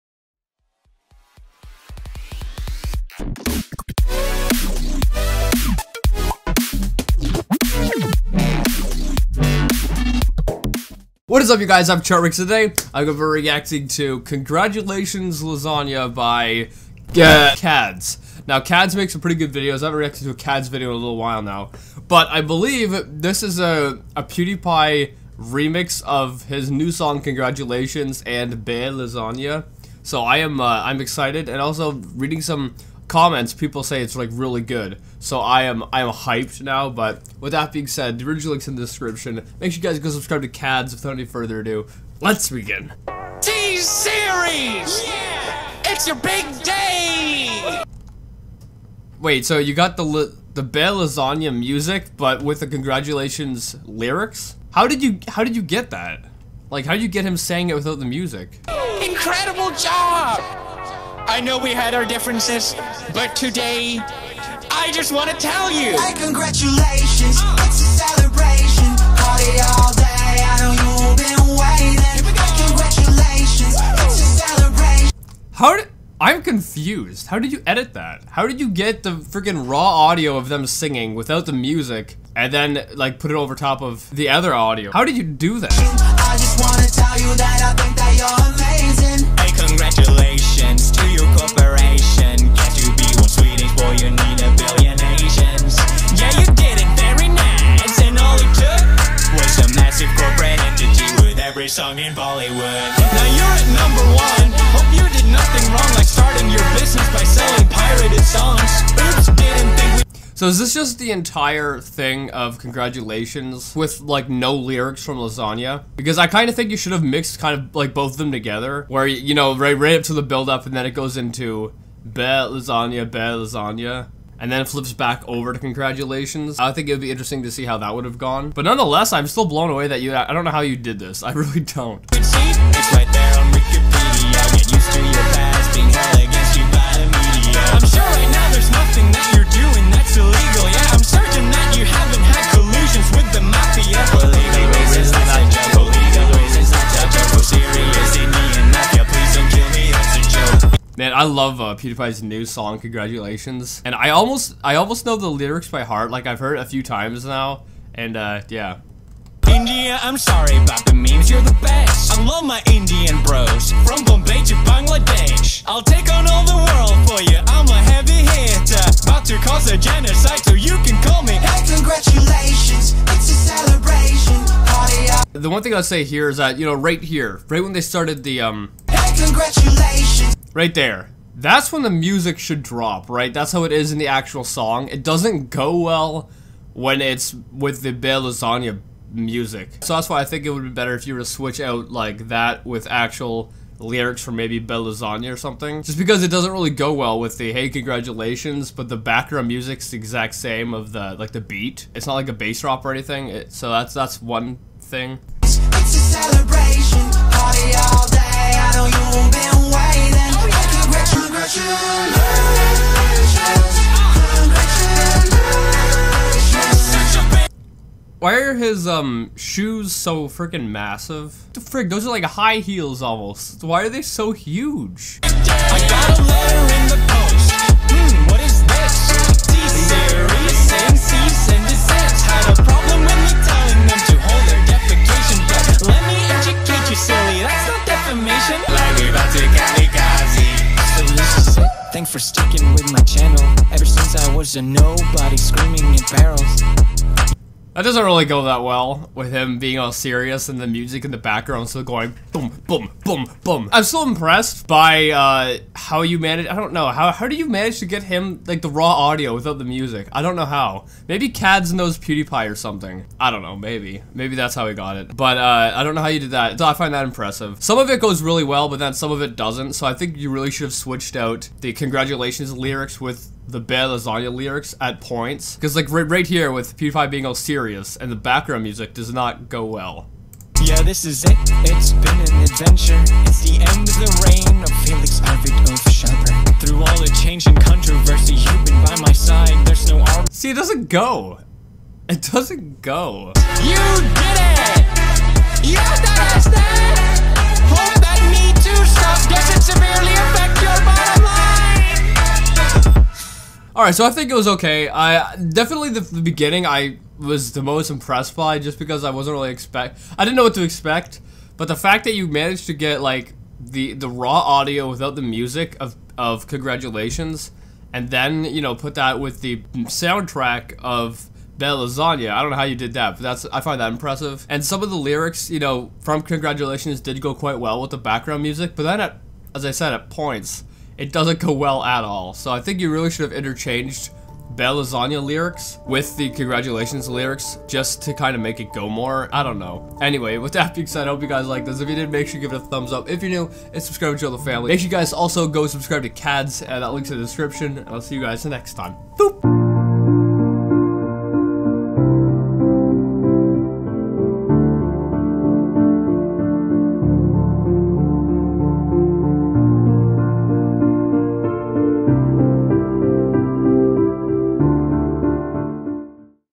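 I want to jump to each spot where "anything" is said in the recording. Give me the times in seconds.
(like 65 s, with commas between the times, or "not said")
202 s.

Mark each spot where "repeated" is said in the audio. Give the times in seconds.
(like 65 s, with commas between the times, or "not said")
not said.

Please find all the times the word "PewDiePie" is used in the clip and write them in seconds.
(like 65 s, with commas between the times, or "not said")
24 s, 151 s, 261 s, 276 s.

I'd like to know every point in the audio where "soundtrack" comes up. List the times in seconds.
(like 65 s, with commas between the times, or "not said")
319 s.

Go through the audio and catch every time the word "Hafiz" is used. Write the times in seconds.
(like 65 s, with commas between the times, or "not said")
not said.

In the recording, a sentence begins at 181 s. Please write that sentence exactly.
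That's when the music should drop, right?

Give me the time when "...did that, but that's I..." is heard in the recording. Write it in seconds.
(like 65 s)
322 s.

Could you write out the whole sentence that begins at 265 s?
But uh, I don't know how you did that.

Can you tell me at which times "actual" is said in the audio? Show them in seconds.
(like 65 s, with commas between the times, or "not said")
184 s, 192 s.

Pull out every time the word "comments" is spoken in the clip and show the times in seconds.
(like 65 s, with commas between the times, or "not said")
33 s.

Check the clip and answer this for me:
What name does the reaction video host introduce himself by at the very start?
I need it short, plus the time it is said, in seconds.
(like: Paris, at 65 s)
Chartrix, at 12 s.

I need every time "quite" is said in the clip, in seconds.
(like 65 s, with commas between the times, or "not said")
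327 s.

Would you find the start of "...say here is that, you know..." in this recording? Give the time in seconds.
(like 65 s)
175 s.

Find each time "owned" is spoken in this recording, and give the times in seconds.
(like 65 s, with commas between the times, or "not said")
not said.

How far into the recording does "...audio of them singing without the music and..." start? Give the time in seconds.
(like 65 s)
80 s.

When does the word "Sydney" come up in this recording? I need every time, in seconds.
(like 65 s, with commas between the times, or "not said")
not said.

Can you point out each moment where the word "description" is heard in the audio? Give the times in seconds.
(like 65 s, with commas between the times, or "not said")
38 s, 347 s.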